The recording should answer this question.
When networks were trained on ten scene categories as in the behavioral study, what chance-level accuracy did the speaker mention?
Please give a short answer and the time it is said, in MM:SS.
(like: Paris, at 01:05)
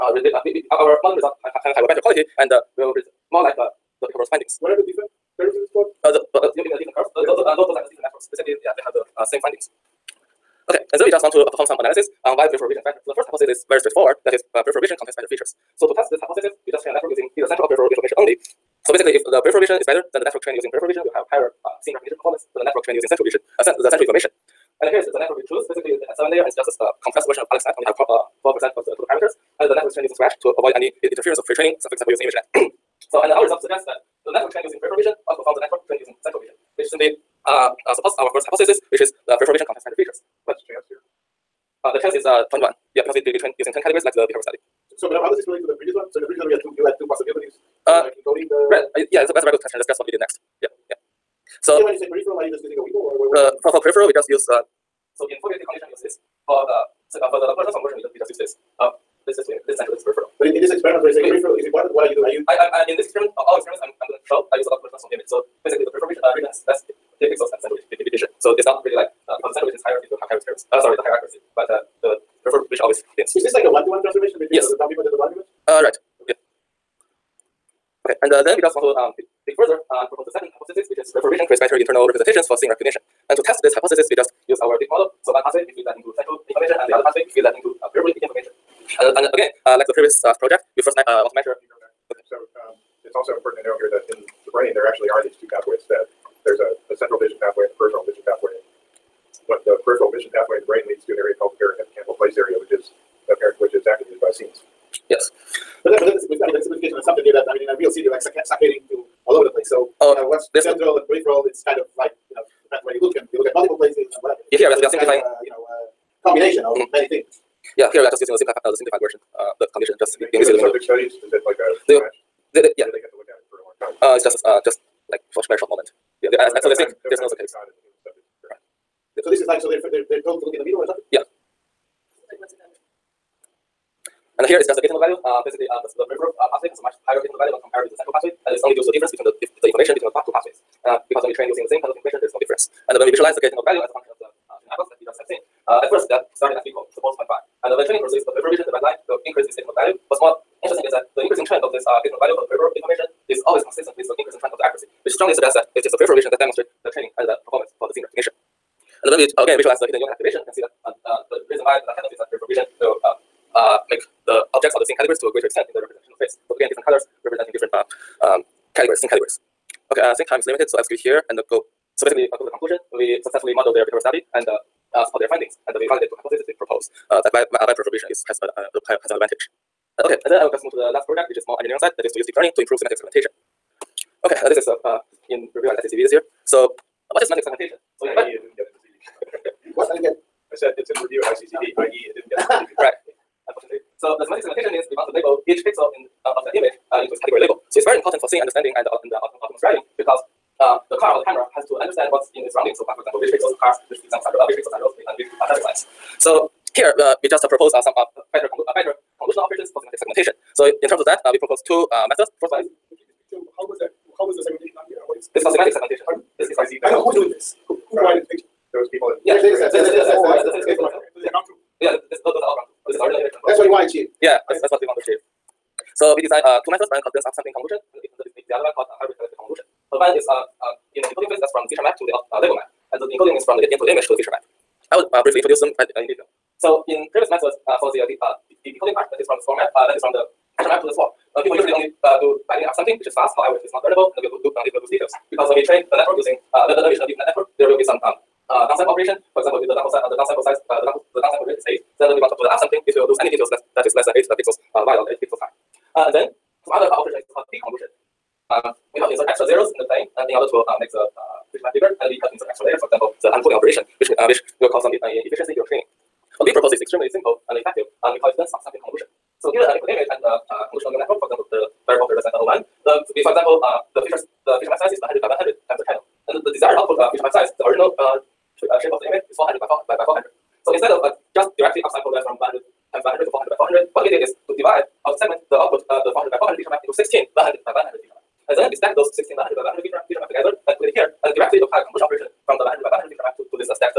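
0.1, at 00:42.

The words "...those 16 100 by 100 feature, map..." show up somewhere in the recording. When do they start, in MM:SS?
04:48.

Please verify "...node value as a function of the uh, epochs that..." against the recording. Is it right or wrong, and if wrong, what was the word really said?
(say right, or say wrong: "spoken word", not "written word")
right.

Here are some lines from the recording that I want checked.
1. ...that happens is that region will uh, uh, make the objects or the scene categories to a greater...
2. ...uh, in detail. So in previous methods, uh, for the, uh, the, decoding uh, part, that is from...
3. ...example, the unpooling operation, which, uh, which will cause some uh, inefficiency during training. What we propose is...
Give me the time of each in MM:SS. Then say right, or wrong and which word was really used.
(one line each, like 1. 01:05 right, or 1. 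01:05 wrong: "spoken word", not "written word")
1. 02:41 wrong: "reprovision", not "region"
2. 03:55 right
3. 04:22 right.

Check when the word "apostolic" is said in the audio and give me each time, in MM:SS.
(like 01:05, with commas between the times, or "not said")
not said.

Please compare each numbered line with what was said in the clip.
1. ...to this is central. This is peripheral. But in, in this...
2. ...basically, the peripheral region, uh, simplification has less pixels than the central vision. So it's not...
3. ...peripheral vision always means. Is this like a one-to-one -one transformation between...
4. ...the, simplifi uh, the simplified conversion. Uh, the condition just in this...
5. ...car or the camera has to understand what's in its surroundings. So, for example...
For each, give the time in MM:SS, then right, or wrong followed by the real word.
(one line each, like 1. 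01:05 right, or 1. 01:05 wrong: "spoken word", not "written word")
1. 00:59 right
2. 01:05 wrong: "region", not "simplification"
3. 01:12 wrong: "thins", not "means"
4. 01:58 wrong: "version", not "conversion"
5. 03:21 right.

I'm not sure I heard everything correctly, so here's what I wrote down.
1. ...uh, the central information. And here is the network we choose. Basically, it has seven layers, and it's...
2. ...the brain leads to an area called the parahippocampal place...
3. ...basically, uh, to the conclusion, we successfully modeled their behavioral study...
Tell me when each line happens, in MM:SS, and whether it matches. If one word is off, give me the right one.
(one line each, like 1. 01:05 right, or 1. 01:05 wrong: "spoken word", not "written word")
1. 00:23 right
2. 01:40 right
3. 02:52 right.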